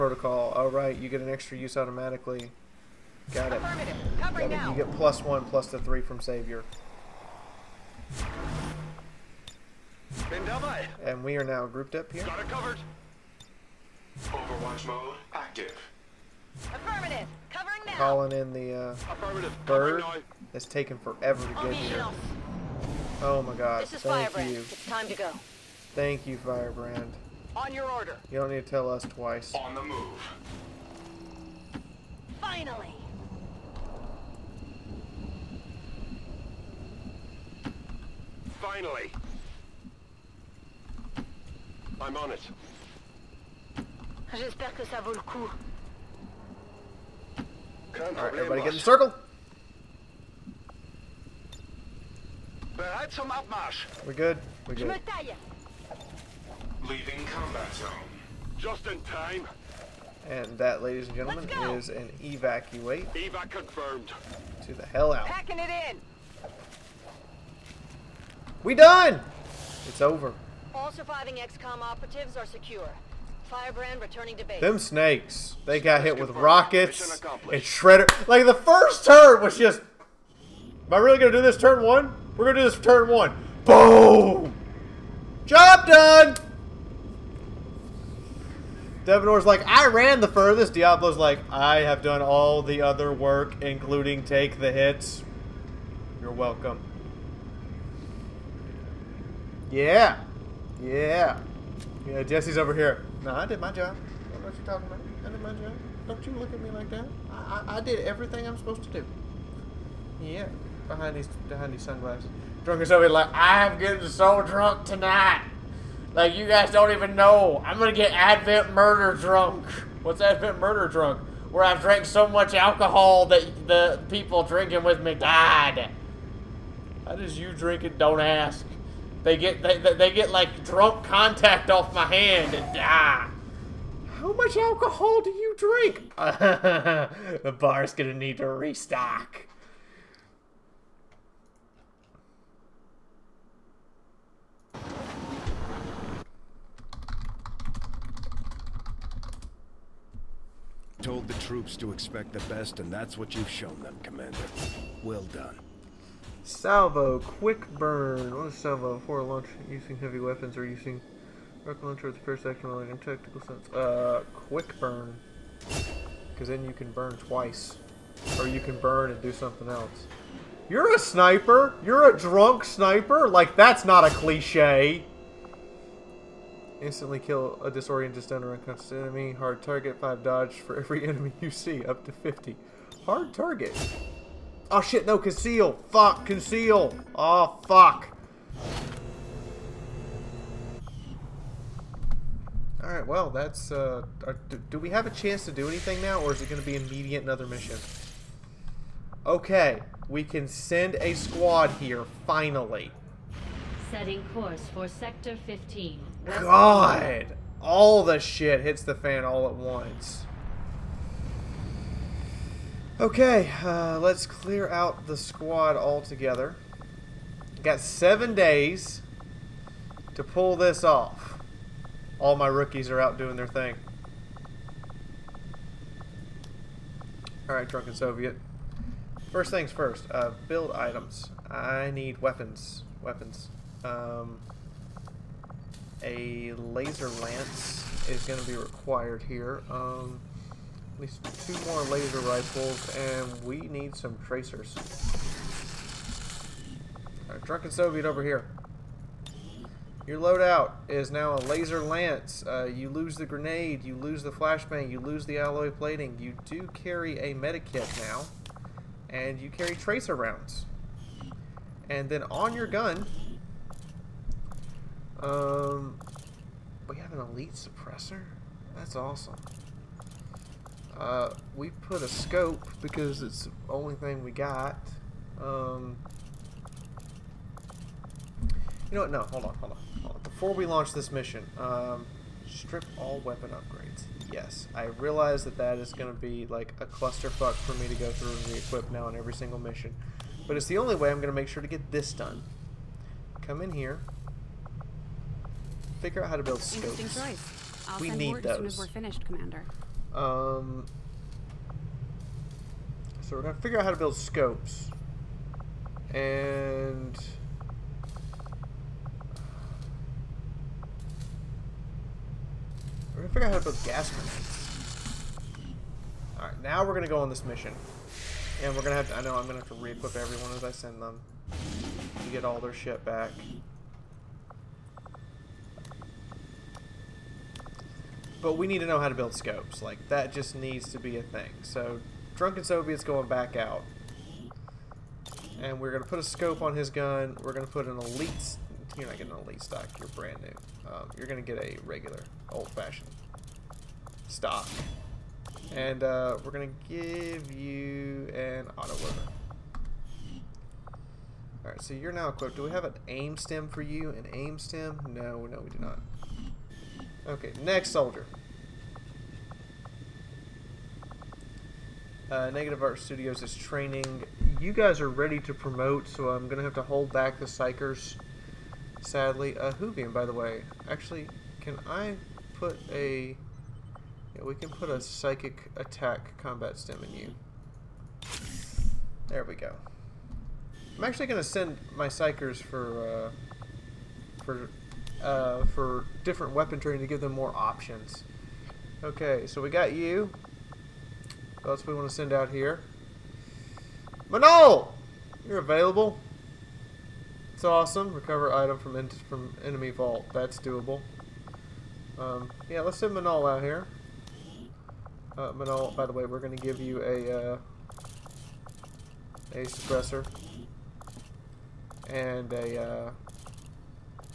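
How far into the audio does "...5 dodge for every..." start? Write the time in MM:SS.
02:59.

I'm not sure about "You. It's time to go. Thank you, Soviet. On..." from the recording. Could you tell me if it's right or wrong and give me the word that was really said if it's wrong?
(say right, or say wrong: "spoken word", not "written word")
wrong: "Firebrand", not "Soviet".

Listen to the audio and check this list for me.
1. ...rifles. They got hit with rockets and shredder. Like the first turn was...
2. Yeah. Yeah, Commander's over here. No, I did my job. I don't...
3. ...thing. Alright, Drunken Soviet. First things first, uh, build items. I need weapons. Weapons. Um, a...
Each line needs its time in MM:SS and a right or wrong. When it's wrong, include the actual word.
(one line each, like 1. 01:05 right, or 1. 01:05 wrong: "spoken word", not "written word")
1. 01:14 wrong: "snakes", not "rifles"
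2. 01:40 wrong: "Jesse", not "Commander"
3. 03:43 right.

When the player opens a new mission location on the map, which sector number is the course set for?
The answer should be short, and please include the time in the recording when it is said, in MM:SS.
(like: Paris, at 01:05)
15, at 03:24.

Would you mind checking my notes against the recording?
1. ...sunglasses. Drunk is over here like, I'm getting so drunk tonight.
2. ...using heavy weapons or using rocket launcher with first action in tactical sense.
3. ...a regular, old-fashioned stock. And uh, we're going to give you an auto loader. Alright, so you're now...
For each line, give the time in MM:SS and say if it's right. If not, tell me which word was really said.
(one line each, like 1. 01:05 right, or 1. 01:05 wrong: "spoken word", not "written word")
1. 01:51 right
2. 02:39 right
3. 05:41 right.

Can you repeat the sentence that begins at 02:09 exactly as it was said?
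They get they, they get like drunk contact off my hand and die.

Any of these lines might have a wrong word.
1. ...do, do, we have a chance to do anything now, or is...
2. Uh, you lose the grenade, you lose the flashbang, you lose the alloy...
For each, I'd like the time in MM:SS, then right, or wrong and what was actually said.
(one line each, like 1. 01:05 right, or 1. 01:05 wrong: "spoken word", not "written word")
1. 03:14 right
2. 04:12 right.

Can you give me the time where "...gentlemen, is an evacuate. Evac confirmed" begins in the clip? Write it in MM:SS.
01:01.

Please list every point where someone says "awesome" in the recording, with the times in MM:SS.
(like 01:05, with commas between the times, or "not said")
04:28, 06:37.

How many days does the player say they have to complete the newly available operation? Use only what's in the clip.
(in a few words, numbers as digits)
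7.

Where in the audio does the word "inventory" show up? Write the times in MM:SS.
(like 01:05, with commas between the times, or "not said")
not said.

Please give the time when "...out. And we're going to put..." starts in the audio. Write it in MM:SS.
05:33.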